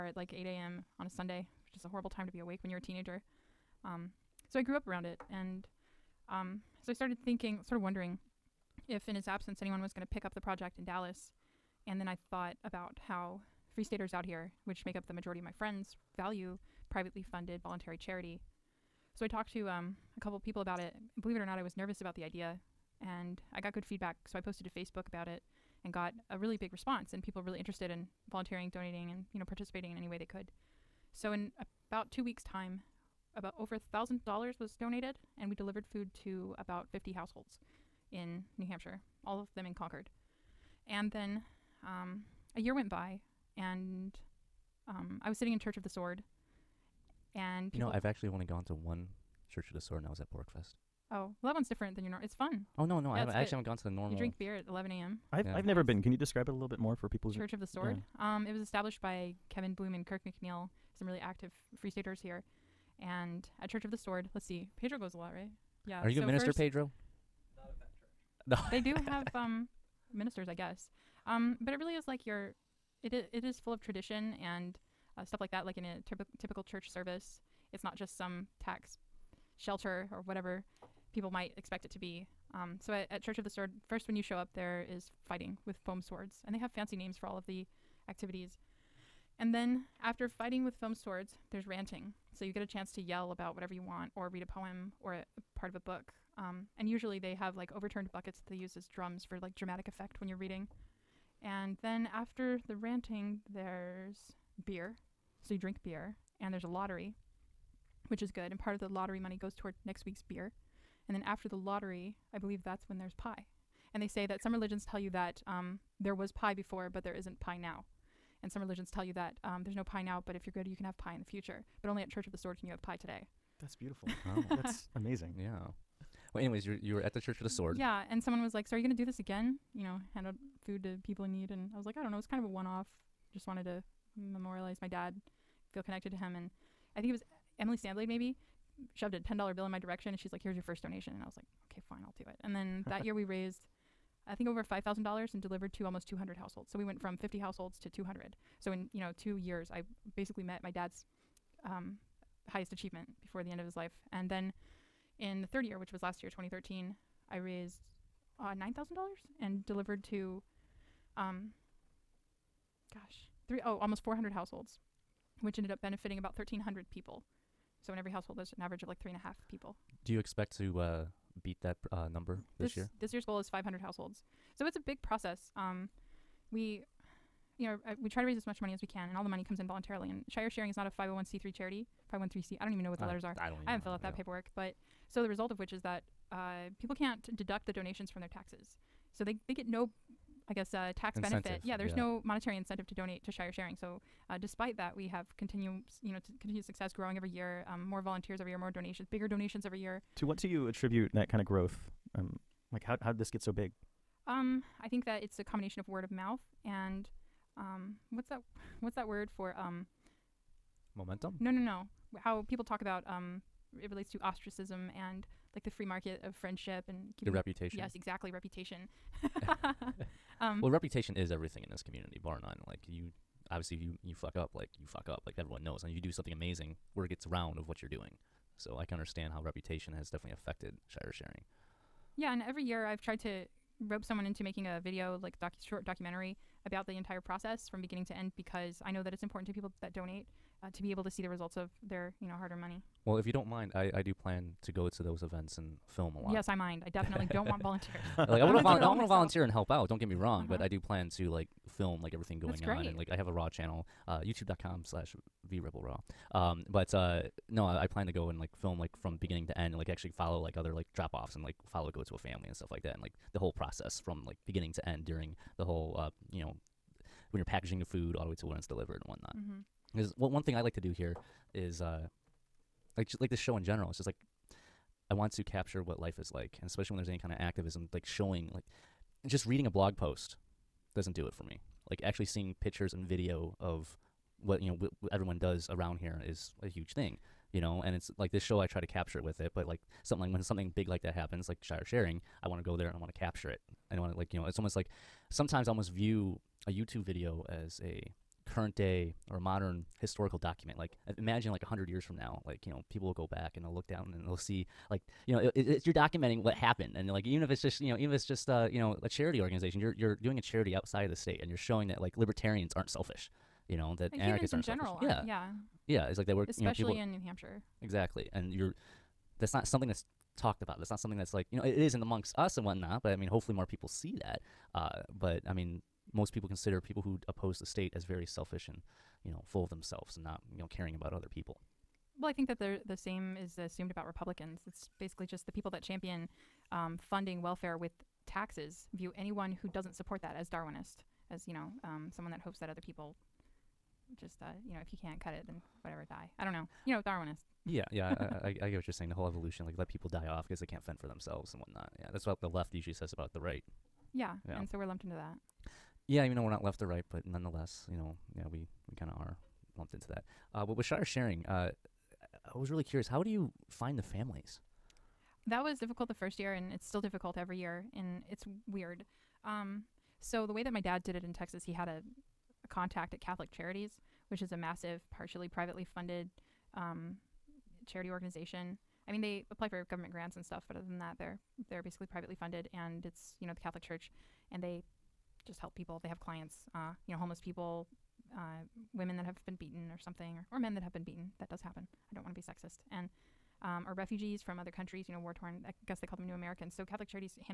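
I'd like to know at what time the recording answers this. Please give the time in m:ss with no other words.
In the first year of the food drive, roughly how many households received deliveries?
0:36.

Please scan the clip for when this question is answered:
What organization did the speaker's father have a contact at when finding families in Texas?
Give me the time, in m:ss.
6:13.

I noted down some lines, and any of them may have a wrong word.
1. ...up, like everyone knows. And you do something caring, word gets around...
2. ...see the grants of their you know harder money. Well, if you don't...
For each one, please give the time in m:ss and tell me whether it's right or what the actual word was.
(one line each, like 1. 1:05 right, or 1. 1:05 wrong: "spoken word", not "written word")
1. 3:45 wrong: "amazing", not "caring"
2. 4:01 wrong: "results", not "grants".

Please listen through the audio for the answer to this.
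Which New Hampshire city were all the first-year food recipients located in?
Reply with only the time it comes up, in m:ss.
0:39.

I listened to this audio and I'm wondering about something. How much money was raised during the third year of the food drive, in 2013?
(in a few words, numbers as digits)
$9,000.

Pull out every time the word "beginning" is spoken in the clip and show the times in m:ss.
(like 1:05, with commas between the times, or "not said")
3:57, 4:19, 4:24.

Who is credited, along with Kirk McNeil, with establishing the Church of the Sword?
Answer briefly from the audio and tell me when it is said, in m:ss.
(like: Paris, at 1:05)
Kevin Bloom, at 0:59.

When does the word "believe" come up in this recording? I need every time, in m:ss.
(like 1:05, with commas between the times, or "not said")
0:21, 1:52.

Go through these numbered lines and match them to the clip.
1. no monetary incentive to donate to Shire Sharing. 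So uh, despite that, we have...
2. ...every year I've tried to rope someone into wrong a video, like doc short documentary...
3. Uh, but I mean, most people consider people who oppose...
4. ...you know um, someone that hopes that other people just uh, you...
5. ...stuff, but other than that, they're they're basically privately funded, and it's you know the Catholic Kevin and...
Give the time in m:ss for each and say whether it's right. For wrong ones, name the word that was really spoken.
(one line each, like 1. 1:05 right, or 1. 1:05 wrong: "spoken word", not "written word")
1. 3:12 right
2. 3:52 wrong: "making", not "wrong"
3. 5:24 right
4. 5:41 right
5. 6:20 wrong: "Church", not "Kevin".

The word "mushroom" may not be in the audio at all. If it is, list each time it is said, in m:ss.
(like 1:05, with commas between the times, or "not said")
not said.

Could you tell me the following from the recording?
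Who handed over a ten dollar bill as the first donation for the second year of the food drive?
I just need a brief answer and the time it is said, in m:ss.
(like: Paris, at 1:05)
Emily Sandblade, at 2:17.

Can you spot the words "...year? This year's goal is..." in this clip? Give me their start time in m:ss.
2:52.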